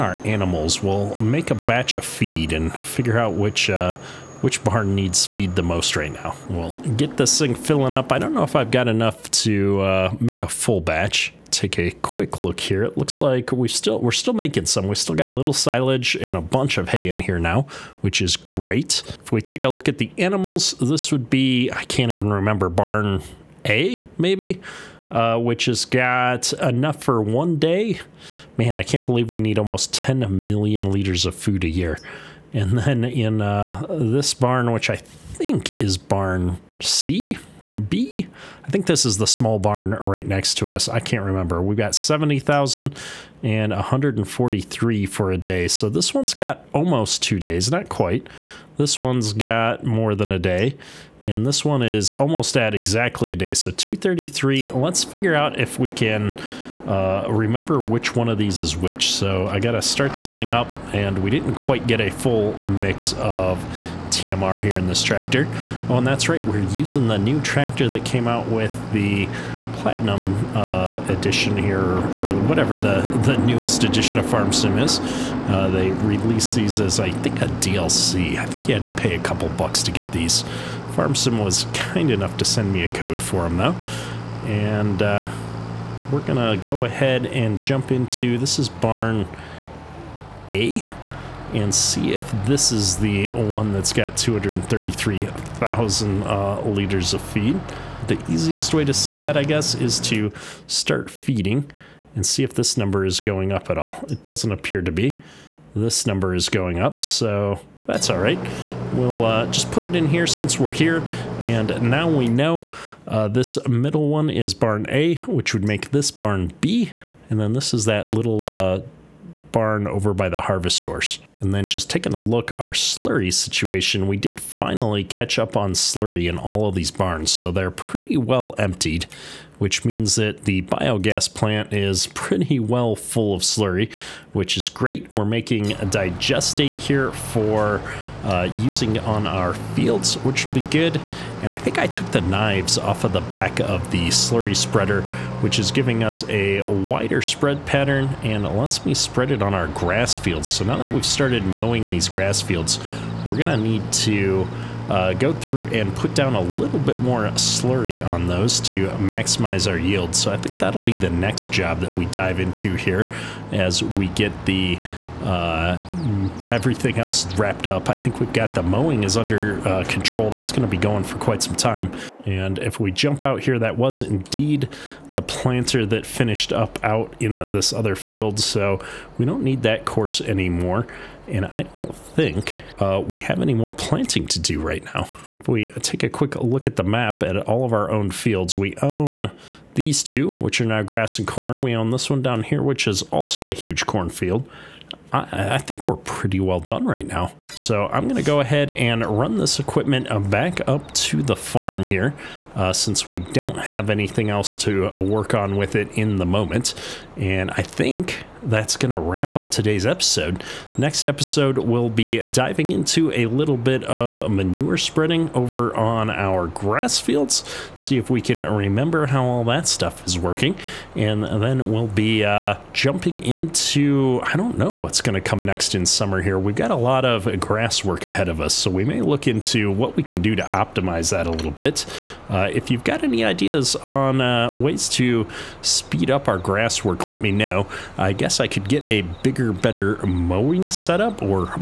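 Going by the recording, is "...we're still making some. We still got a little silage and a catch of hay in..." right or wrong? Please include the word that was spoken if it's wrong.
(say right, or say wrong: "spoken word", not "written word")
wrong: "bunch", not "catch".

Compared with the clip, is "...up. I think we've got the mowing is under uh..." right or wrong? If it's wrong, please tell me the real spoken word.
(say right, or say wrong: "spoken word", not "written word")
right.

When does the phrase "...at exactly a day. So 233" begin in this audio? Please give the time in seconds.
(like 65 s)
52 s.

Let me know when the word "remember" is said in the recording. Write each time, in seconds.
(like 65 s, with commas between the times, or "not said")
22 s, 41 s, 57 s, 218 s.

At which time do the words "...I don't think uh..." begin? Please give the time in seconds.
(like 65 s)
181 s.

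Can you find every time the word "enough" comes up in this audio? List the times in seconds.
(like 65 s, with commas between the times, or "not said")
8 s, 26 s, 82 s.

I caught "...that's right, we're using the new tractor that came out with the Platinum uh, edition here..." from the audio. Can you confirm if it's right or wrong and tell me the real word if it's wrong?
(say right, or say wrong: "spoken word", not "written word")
right.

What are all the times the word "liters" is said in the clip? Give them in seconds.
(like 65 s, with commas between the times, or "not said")
30 s, 96 s.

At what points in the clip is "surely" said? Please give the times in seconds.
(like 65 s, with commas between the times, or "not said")
not said.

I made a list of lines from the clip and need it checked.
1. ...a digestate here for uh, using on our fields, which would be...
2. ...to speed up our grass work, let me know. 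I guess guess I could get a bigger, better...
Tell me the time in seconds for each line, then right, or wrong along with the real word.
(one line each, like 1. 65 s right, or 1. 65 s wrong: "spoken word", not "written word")
1. 135 s right
2. 234 s right.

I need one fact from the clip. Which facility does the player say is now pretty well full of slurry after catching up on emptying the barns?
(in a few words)
biogas plant.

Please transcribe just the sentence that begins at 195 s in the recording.
I, I, think we're pretty well done right now.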